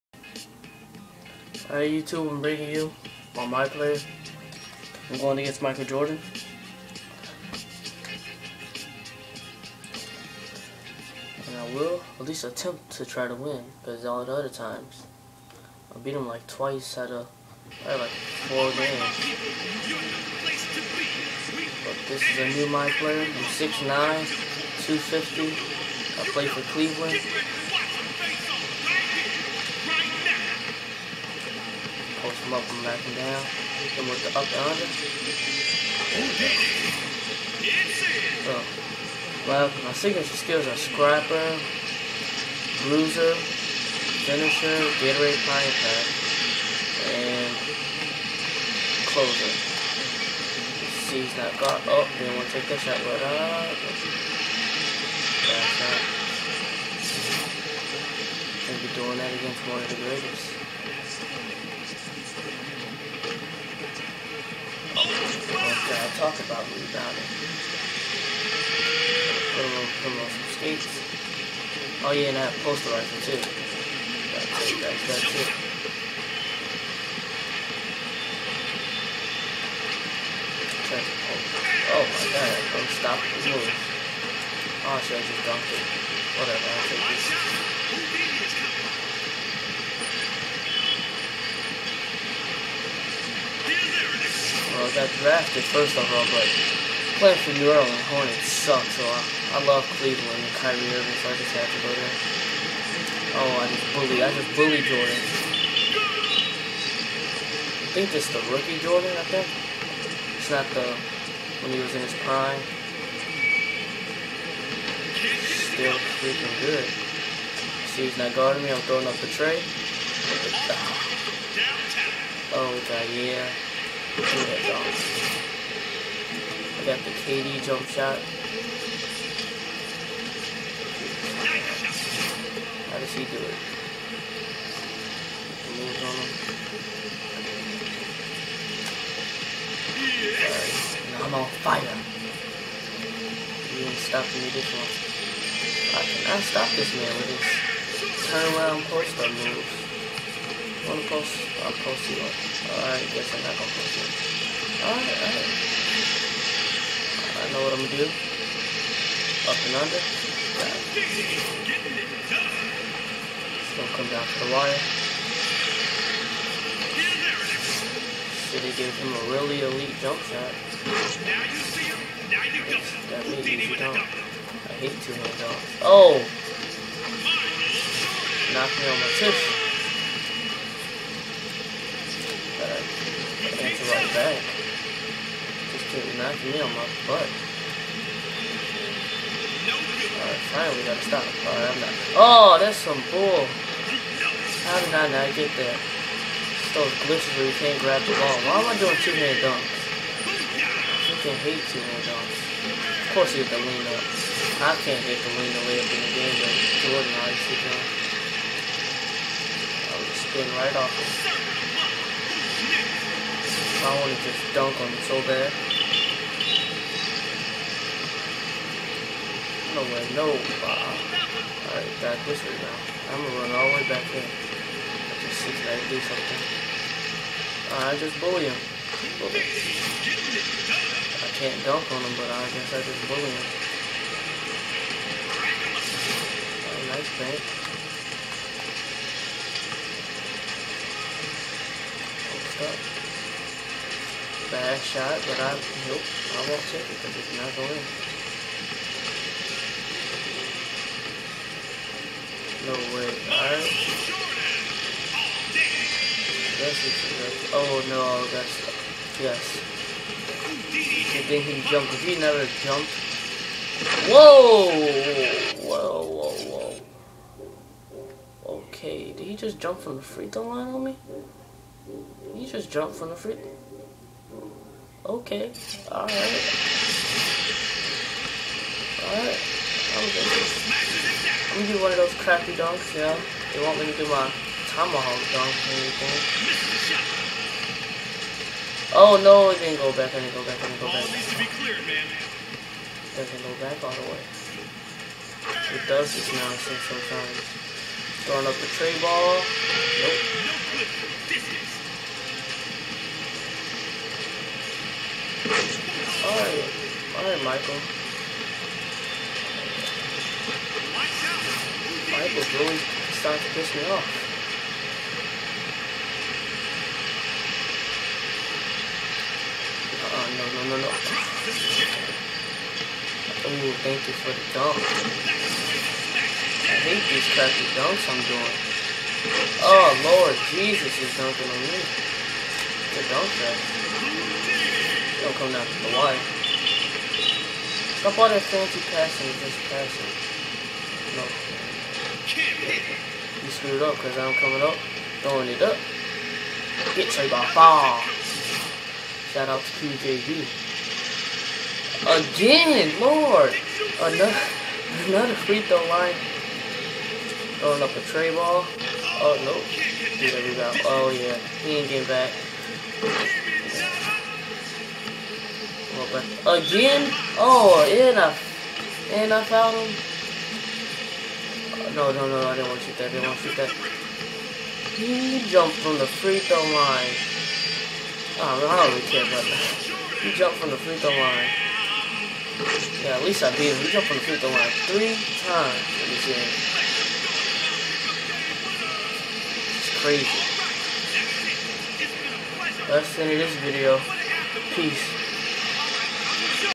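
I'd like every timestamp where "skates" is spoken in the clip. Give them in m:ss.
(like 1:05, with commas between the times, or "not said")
1:10.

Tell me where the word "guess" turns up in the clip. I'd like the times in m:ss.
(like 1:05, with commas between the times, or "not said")
2:33, 3:52.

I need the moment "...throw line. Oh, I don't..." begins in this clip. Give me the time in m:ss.
6:16.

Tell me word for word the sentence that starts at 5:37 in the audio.
Stop all that fancy passing, just passing.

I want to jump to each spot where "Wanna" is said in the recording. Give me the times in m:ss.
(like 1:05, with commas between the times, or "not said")
2:30.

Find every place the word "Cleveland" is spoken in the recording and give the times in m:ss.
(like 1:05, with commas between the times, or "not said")
0:26, 1:40.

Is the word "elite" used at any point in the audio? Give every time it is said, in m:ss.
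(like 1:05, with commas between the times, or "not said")
2:49.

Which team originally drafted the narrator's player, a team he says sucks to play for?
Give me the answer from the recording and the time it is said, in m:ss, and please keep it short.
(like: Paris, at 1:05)
New Orleans Hornets, at 1:37.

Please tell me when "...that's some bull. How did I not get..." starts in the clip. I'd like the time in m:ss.
3:12.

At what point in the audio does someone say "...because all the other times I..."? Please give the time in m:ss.
0:13.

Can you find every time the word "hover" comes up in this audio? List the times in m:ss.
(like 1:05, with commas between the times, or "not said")
not said.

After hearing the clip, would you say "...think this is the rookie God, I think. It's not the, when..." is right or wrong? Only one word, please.
wrong.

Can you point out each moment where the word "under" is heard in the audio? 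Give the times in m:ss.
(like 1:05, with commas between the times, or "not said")
0:34, 2:39.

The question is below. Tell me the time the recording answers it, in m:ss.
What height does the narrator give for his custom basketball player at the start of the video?
0:23.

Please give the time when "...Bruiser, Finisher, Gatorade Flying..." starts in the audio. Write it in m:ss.
0:42.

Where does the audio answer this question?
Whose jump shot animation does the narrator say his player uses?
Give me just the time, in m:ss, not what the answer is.
2:07.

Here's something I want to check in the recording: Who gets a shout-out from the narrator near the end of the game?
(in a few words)
QJV.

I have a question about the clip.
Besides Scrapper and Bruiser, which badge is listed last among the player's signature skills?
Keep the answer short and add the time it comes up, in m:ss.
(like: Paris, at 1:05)
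Closer, at 0:49.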